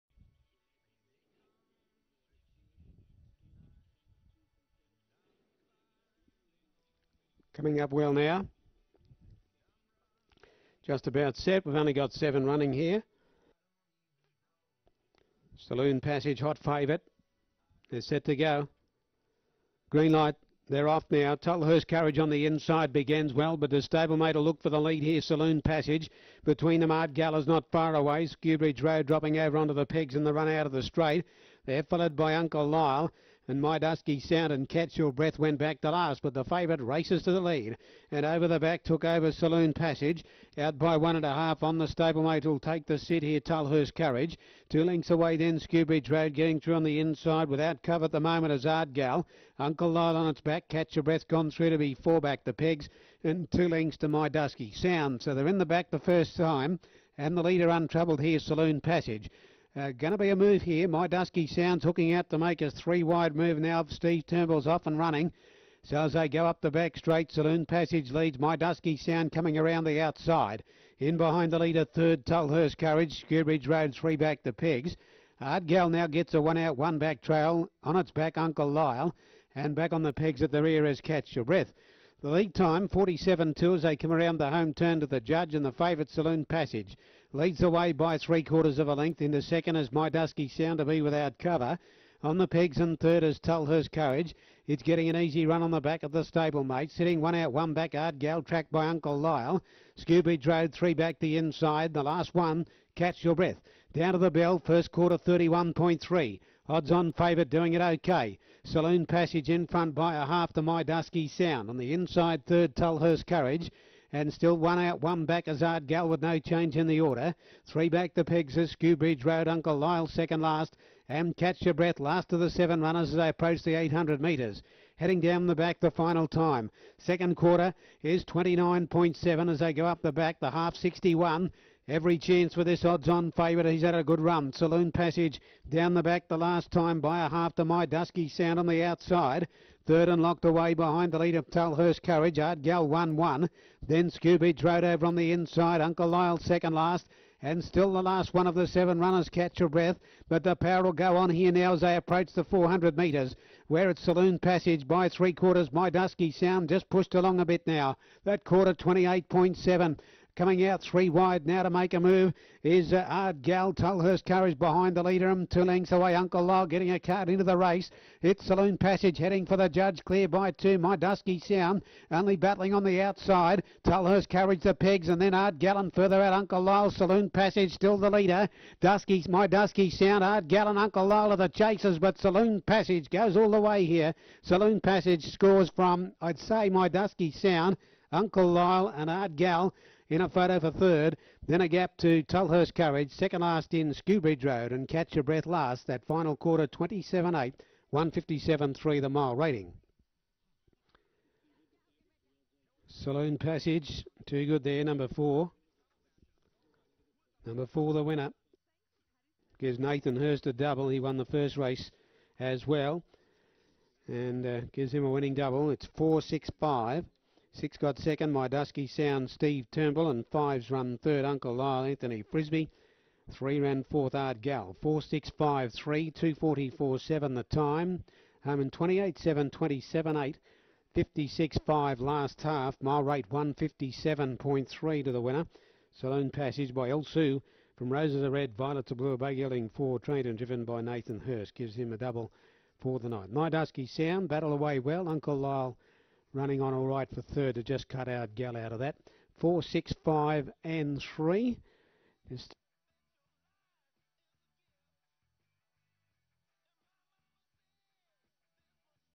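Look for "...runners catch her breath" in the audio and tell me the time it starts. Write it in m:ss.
2:28.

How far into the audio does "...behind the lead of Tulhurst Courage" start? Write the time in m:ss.
2:20.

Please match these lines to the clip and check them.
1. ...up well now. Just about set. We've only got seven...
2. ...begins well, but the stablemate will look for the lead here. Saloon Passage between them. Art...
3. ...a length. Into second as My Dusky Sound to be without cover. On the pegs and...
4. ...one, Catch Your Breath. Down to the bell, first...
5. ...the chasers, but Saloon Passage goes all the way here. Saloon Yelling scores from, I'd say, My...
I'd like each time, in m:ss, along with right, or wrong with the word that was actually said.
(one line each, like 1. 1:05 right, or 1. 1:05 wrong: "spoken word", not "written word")
1. 0:07 right
2. 0:22 right
3. 1:28 right
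4. 1:42 right
5. 3:01 wrong: "Passage", not "Yelling".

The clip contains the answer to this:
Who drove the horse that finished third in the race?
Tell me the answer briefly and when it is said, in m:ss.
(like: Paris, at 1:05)
Anthony Frisby, at 3:41.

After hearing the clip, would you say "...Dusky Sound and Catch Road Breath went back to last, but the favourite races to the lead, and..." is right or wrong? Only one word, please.
wrong.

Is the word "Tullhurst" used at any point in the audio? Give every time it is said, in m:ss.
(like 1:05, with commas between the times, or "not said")
0:21, 1:12, 1:33.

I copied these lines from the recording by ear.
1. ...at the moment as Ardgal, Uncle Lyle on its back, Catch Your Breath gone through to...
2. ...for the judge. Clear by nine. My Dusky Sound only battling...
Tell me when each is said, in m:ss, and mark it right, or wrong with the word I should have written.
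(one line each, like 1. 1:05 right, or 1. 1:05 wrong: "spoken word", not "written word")
1. 0:48 right
2. 2:49 wrong: "two", not "nine".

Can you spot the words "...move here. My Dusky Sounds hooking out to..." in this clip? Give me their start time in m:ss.
1:00.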